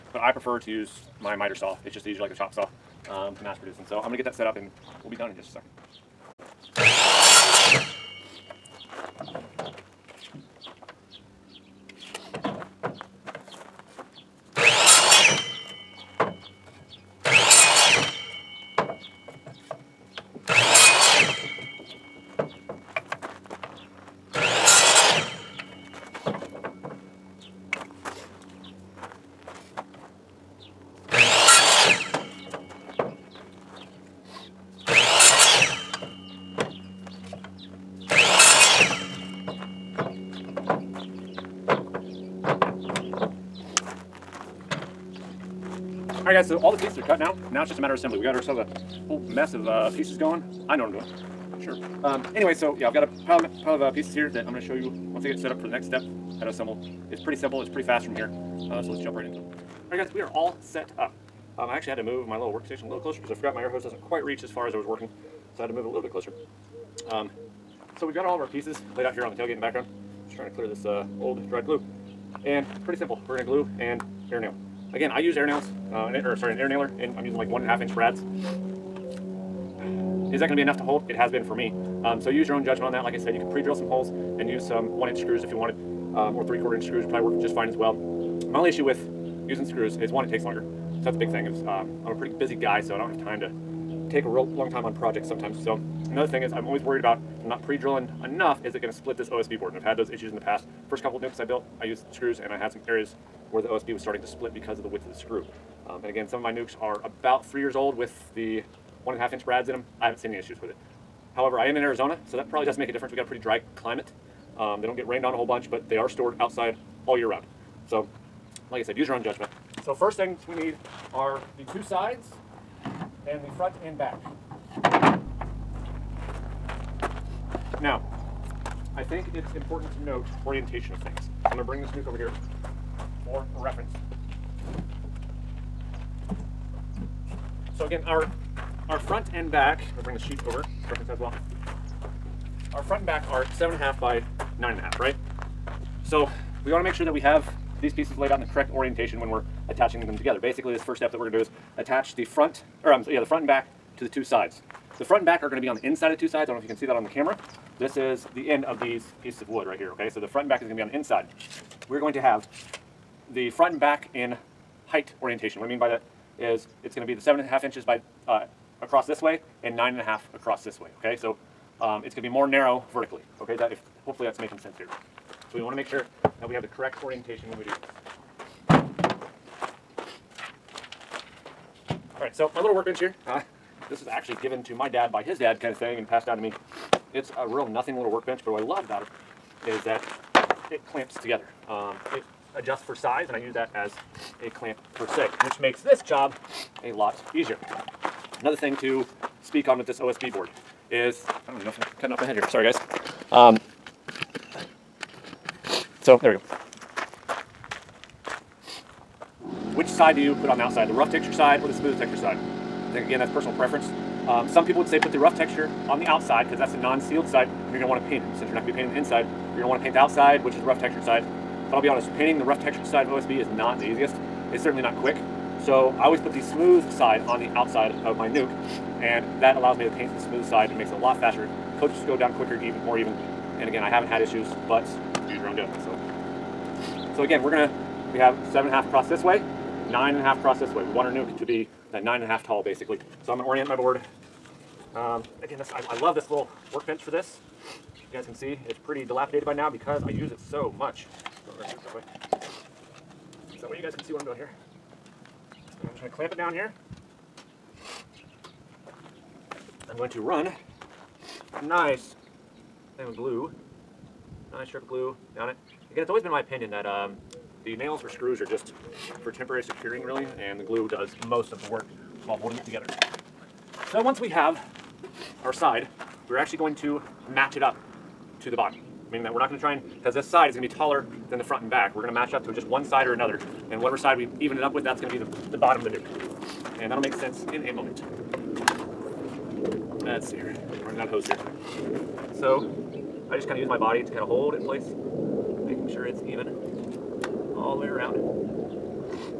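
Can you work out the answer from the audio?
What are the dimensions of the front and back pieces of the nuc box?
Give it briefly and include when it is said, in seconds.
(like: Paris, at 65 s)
7.5 by 9.5 inches, at 143 s.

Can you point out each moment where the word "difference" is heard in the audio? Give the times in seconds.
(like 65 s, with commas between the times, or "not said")
112 s.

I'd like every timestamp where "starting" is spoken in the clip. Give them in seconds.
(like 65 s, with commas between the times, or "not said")
103 s.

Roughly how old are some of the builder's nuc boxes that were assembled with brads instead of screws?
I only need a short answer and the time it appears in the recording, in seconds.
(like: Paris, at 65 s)
3 years, at 107 s.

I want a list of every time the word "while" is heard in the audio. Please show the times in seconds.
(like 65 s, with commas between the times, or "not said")
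272 s.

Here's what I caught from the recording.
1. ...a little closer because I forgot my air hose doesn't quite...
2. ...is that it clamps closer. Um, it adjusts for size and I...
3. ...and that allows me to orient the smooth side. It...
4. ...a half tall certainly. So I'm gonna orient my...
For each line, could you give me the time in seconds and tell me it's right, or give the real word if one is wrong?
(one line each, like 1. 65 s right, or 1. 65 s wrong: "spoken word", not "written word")
1. 62 s right
2. 189 s wrong: "together", not "closer"
3. 229 s wrong: "paint", not "orient"
4. 242 s wrong: "basically", not "certainly".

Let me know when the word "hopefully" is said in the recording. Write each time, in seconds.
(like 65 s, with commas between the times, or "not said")
174 s.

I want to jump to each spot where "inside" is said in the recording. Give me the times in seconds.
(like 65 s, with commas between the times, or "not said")
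155 s, 160 s, 218 s.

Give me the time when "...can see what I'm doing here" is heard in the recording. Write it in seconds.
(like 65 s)
253 s.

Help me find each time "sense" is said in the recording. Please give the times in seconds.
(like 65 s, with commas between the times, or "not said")
174 s, 287 s.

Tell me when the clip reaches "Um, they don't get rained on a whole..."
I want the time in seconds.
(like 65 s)
114 s.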